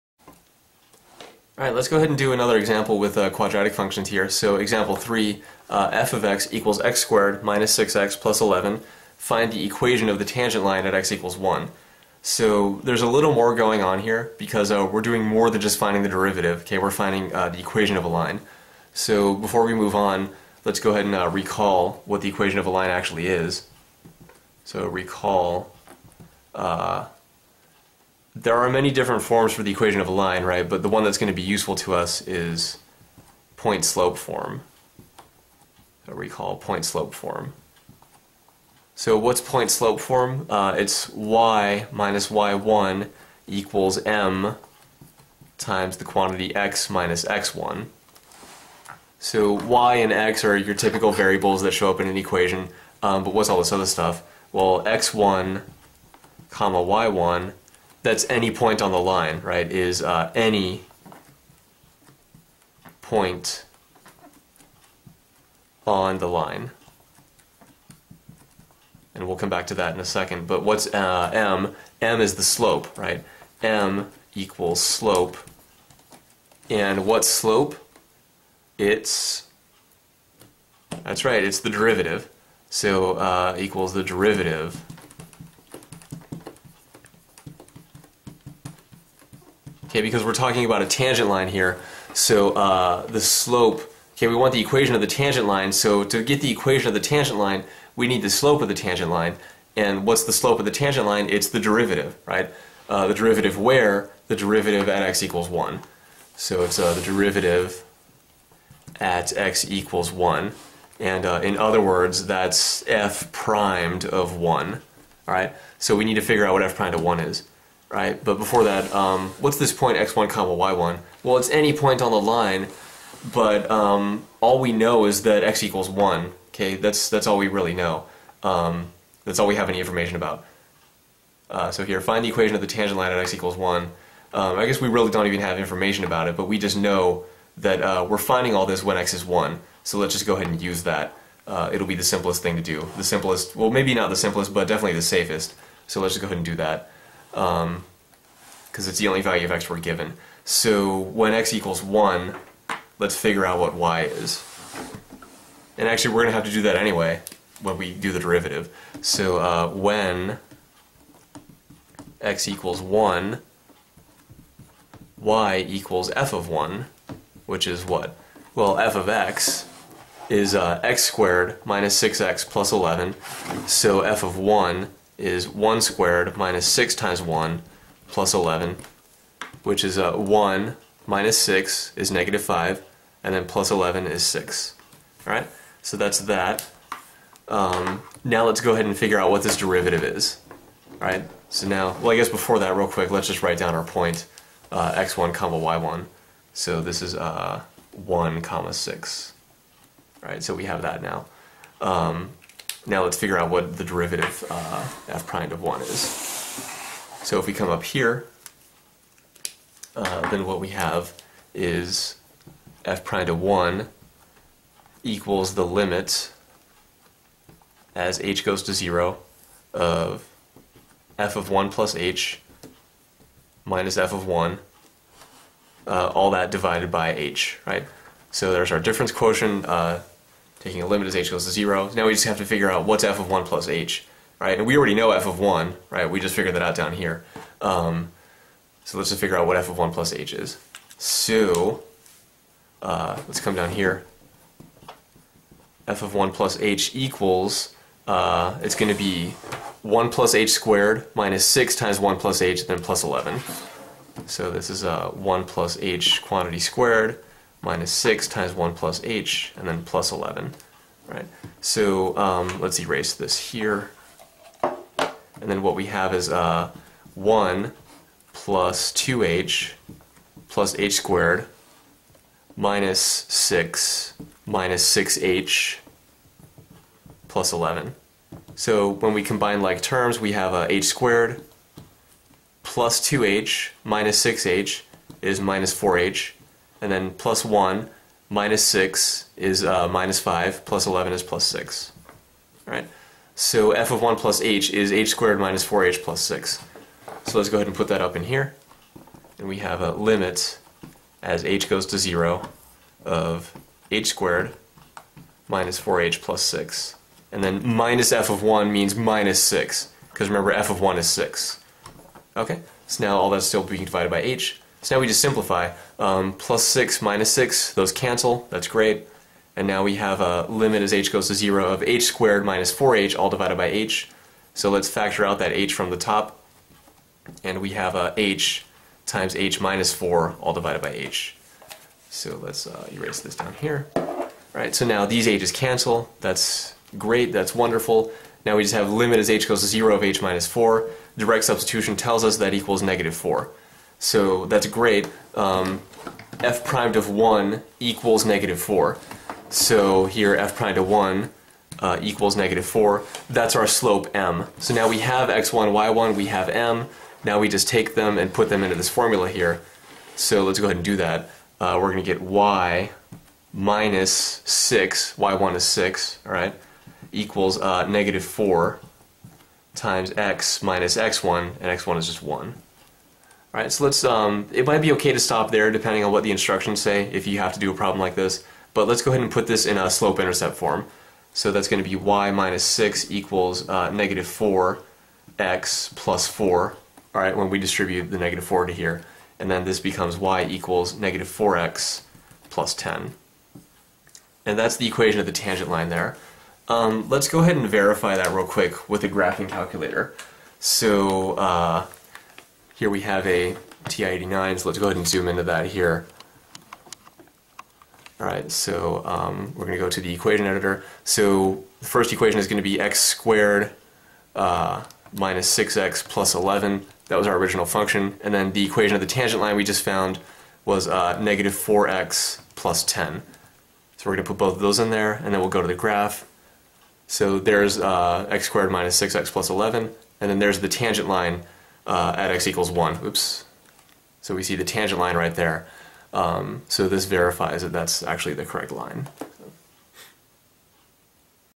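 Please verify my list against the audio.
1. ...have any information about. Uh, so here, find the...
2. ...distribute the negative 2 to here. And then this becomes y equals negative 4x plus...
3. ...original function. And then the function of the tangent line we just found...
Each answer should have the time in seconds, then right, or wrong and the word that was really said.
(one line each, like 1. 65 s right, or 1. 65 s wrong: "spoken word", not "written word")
1. 129 s right
2. 387 s wrong: "4", not "2"
3. 417 s wrong: "equation", not "function".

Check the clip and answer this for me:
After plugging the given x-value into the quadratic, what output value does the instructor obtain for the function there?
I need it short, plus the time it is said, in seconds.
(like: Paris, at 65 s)
6, at 183 s.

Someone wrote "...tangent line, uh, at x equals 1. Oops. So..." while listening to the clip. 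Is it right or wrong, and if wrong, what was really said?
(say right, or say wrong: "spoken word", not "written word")
right.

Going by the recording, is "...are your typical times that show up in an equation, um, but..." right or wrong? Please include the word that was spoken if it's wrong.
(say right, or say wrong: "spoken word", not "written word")
wrong: "variables", not "times".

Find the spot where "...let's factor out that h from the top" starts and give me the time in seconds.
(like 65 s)
324 s.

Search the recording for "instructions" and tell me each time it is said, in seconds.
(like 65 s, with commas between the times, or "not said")
376 s.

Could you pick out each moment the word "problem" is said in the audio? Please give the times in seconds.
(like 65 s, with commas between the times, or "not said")
377 s.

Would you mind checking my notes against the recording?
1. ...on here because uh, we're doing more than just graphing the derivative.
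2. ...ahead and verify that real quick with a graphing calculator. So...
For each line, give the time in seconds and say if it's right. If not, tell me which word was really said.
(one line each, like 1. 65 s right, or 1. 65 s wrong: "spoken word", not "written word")
1. 13 s wrong: "finding", not "graphing"
2. 397 s right.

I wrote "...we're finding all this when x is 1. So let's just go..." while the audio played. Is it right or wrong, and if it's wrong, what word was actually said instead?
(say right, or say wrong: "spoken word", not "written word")
right.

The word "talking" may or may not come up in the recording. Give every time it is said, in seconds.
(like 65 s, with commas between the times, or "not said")
90 s.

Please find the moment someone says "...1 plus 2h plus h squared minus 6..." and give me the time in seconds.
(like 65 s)
267 s.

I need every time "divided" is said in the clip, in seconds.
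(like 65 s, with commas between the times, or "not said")
226 s, 313 s, 323 s, 330 s.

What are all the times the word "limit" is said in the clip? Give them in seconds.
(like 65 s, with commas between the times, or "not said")
215 s, 230 s, 299 s, 320 s, 338 s.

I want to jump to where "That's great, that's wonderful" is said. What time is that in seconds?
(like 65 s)
336 s.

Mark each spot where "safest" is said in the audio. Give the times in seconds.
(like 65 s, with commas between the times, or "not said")
145 s.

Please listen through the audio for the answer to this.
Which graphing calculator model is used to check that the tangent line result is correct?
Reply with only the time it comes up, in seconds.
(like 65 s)
403 s.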